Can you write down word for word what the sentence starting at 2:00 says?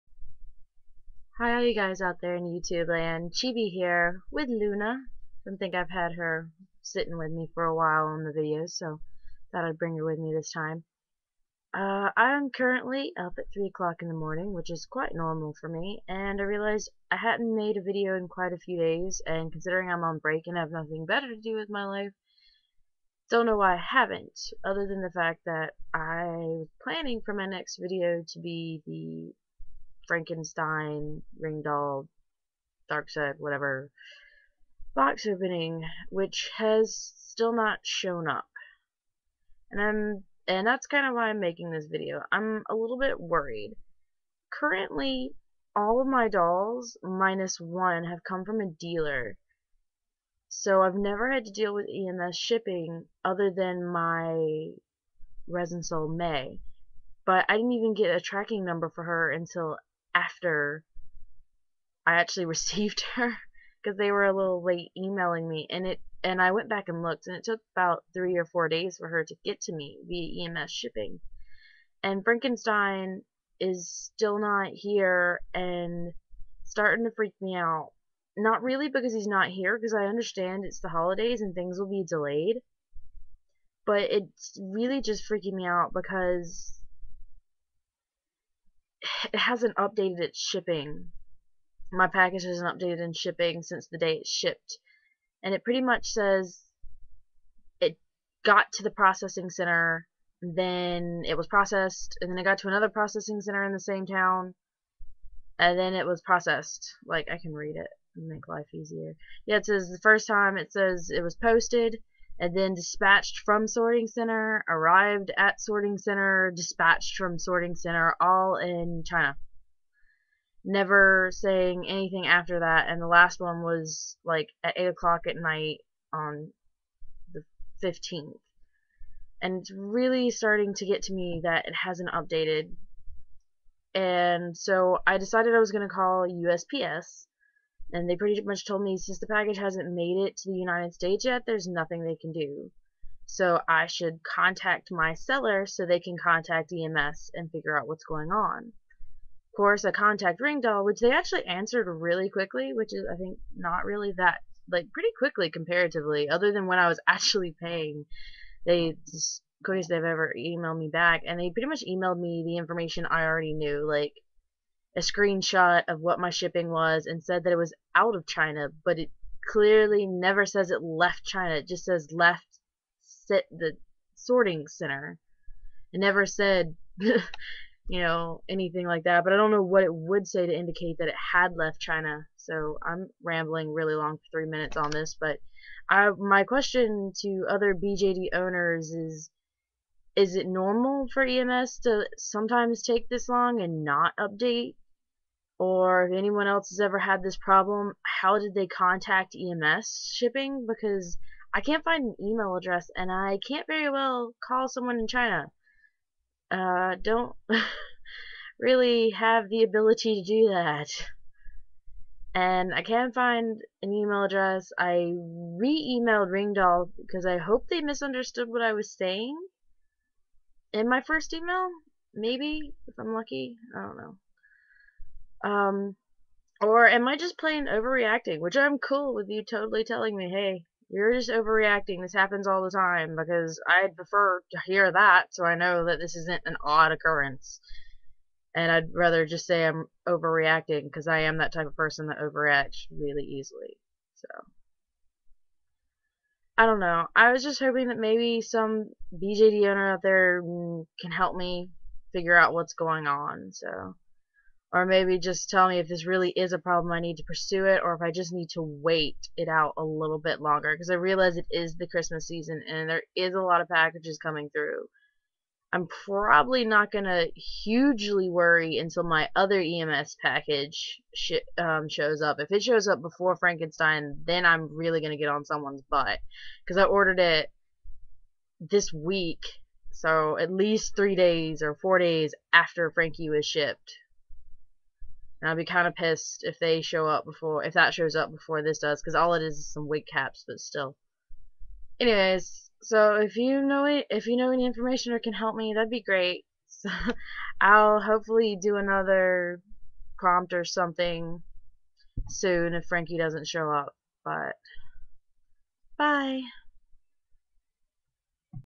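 Never saying anything after that, and the last one was like at 8 o'clock at night on the 15th.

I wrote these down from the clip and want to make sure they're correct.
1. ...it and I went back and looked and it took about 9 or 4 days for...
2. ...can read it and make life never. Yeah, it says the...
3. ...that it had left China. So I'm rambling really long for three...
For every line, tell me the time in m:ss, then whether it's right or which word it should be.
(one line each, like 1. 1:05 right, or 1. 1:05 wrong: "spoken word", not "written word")
1. 1:05 wrong: "3", not "9"
2. 1:47 wrong: "easier", not "never"
3. 3:00 right.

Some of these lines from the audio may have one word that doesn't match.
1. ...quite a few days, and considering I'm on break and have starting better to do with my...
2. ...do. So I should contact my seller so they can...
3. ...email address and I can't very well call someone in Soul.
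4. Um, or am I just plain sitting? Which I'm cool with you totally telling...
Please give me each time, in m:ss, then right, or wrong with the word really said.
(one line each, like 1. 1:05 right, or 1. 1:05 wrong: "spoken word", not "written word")
1. 0:18 wrong: "nothing", not "starting"
2. 2:22 right
3. 3:22 wrong: "China", not "Soul"
4. 3:45 wrong: "overreacting", not "sitting".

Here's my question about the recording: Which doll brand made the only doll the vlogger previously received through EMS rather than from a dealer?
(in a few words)
Resin Soul.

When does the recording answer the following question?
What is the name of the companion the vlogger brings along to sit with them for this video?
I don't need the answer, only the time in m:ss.
0:04.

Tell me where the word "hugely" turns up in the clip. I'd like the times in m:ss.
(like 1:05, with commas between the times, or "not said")
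4:27.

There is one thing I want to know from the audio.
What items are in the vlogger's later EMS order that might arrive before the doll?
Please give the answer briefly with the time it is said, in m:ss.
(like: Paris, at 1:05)
wig caps, at 4:49.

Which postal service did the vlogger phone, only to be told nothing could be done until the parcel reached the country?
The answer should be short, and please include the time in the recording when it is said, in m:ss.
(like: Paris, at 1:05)
USPS, at 2:16.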